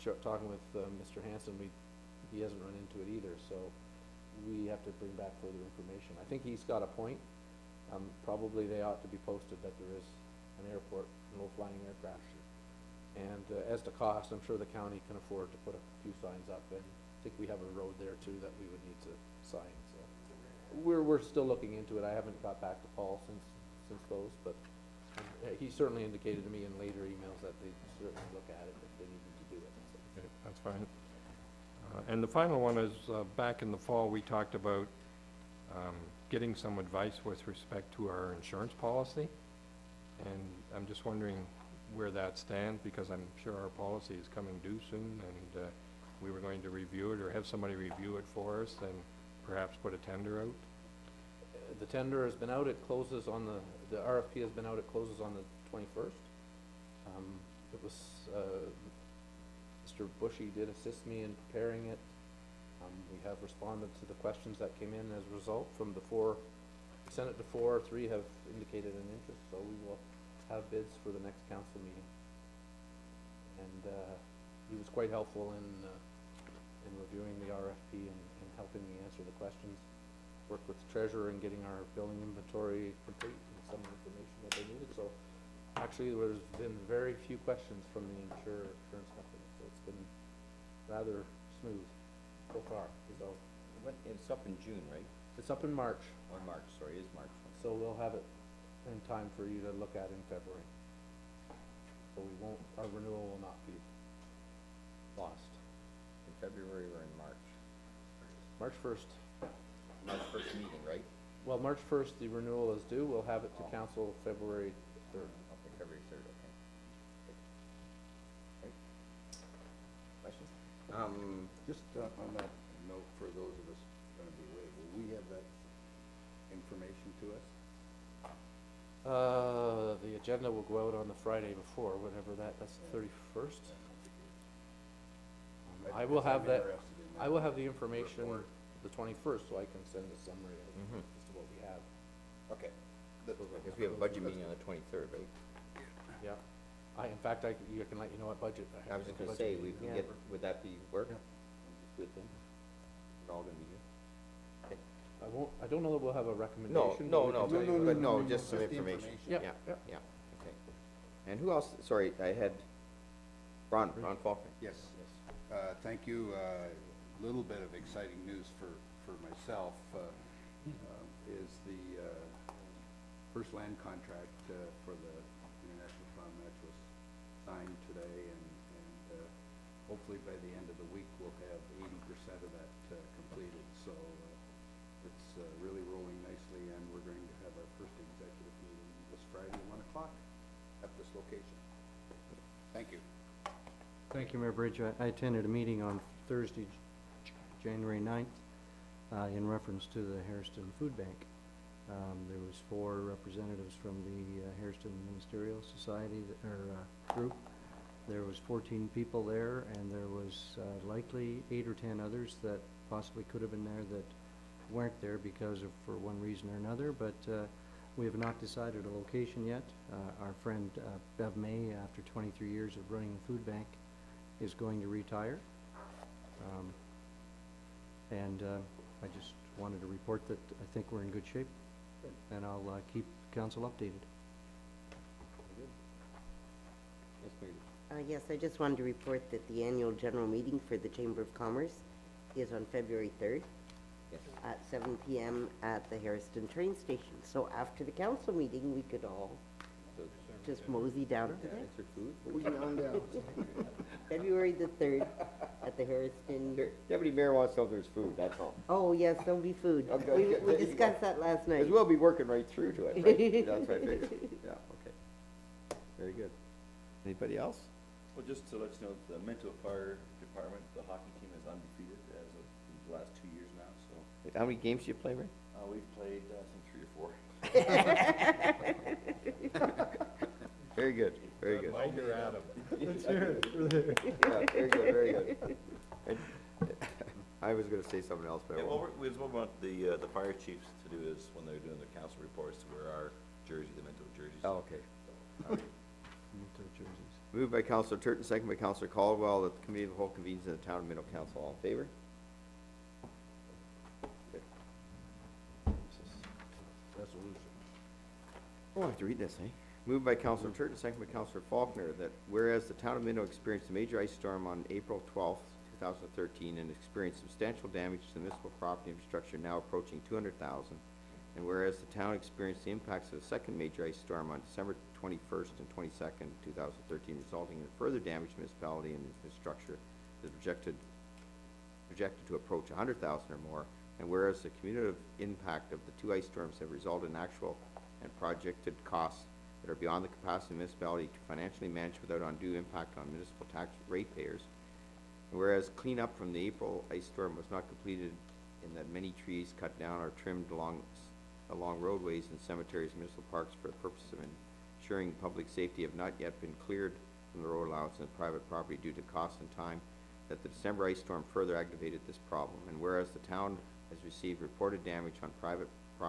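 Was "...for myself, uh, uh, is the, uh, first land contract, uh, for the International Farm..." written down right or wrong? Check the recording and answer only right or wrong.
right.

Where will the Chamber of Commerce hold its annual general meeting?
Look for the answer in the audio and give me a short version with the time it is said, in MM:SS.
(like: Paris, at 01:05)
Harriston train station, at 04:05.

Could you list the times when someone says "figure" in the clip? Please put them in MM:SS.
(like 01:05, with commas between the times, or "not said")
not said.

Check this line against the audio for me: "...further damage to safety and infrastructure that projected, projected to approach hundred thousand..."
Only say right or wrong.
wrong.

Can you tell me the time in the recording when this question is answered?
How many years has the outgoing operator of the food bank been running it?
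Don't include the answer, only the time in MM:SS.
03:42.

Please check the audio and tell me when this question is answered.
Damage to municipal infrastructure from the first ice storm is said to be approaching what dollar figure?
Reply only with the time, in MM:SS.
05:20.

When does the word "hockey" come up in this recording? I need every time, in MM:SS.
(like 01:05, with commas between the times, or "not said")
04:30.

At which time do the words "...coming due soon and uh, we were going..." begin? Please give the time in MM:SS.
00:44.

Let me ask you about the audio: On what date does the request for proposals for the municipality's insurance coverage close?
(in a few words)
21st.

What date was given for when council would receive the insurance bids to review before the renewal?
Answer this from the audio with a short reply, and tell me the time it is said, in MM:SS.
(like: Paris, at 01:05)
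February 3, at 01:53.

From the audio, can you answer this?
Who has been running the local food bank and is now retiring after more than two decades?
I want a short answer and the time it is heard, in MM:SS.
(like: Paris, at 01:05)
Bev May, at 03:41.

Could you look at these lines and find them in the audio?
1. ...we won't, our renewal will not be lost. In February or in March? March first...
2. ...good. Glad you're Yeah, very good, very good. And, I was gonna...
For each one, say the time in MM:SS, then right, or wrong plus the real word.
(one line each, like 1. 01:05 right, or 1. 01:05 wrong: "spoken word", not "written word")
1. 01:42 right
2. 04:41 right.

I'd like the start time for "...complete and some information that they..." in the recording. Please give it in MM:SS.
01:23.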